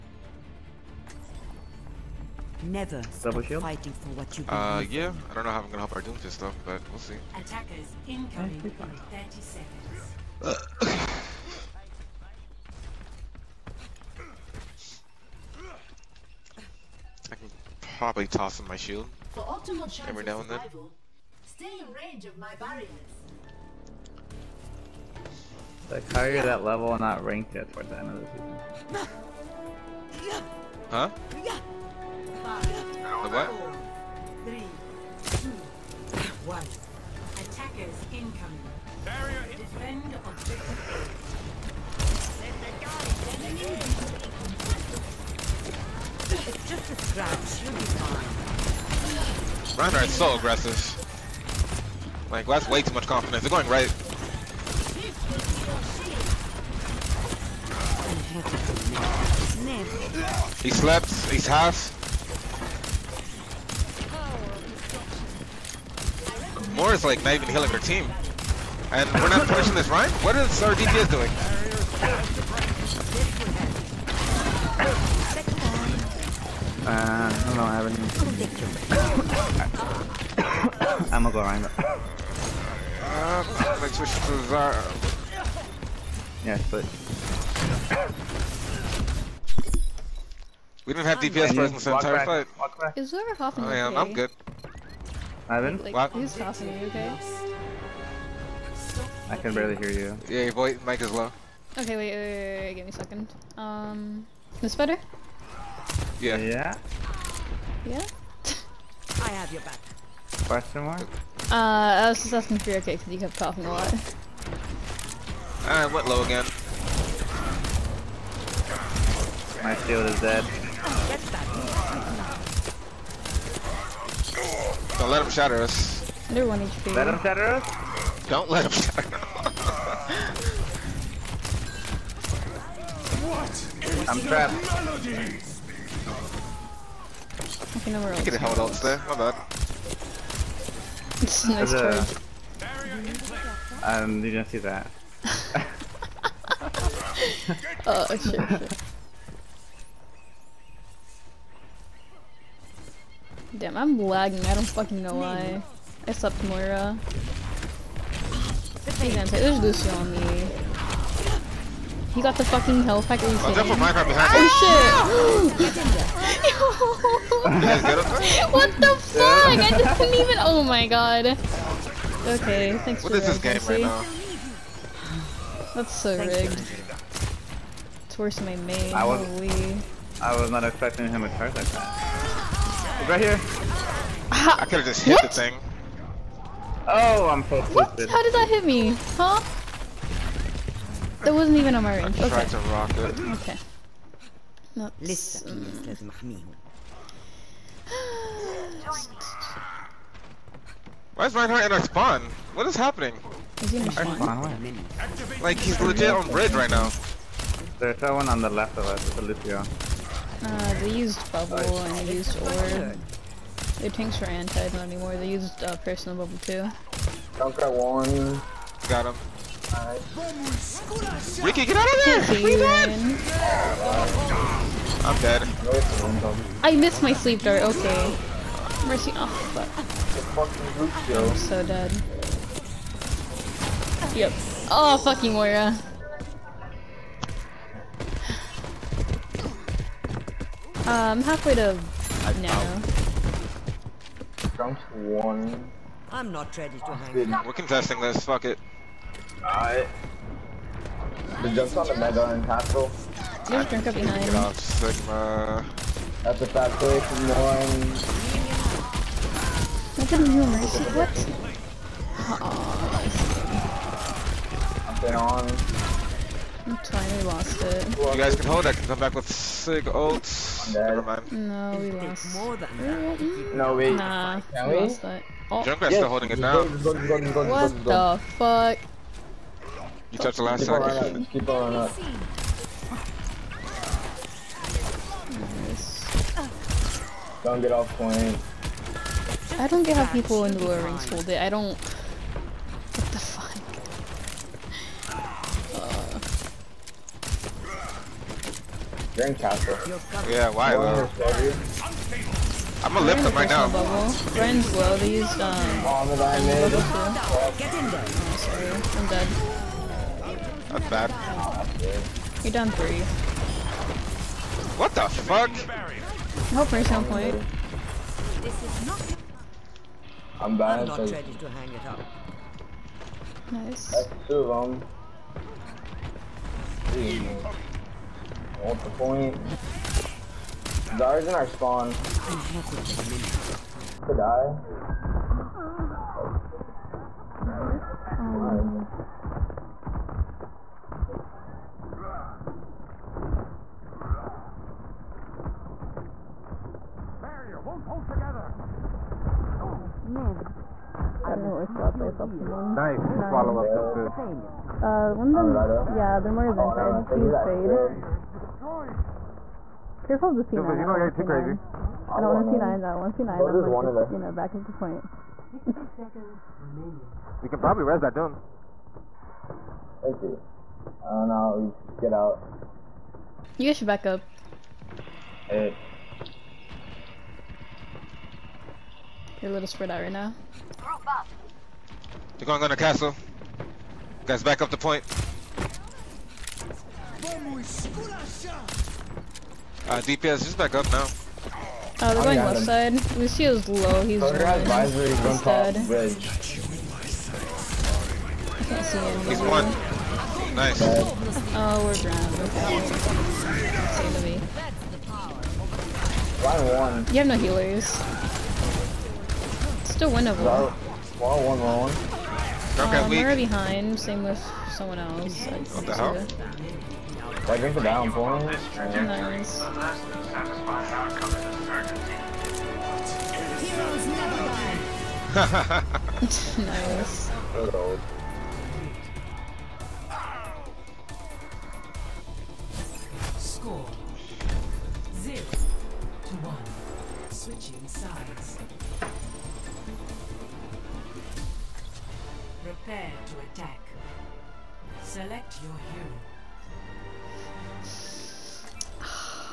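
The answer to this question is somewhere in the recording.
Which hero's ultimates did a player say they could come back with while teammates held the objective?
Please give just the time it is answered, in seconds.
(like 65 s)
269 s.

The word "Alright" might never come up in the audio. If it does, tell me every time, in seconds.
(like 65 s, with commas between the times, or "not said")
249 s.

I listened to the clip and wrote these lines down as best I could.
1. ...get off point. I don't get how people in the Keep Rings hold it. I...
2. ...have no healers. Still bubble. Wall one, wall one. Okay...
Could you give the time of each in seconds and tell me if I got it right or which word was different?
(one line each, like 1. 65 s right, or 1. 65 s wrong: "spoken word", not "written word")
1. 287 s wrong: "Lord", not "Keep"
2. 407 s wrong: "winnable", not "bubble".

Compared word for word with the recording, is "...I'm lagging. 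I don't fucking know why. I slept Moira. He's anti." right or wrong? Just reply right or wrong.
right.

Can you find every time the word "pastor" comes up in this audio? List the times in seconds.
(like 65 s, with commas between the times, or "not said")
not said.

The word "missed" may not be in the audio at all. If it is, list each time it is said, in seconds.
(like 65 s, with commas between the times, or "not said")
226 s.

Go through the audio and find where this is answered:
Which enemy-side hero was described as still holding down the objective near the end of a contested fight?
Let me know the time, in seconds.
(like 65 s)
275 s.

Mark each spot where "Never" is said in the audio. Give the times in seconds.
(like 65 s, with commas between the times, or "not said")
2 s, 270 s.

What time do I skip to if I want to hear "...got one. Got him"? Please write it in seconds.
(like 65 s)
217 s.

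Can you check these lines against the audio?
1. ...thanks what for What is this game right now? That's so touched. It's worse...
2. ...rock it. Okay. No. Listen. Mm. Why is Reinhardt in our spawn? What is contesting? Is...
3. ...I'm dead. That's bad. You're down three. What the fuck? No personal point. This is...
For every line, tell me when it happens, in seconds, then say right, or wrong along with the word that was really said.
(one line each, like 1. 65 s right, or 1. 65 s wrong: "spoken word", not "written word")
1. 172 s wrong: "rigged", not "touched"
2. 192 s wrong: "happening", not "contesting"
3. 310 s right.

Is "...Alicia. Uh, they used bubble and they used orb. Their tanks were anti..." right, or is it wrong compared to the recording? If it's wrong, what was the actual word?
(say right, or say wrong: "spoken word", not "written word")
right.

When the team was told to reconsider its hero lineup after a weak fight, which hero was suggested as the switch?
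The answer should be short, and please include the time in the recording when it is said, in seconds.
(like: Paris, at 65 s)
Zarya, at 84 s.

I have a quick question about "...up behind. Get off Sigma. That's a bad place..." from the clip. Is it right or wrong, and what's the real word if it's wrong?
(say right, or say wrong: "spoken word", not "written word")
right.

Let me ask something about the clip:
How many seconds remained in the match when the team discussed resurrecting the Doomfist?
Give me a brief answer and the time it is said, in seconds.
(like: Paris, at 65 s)
60, at 365 s.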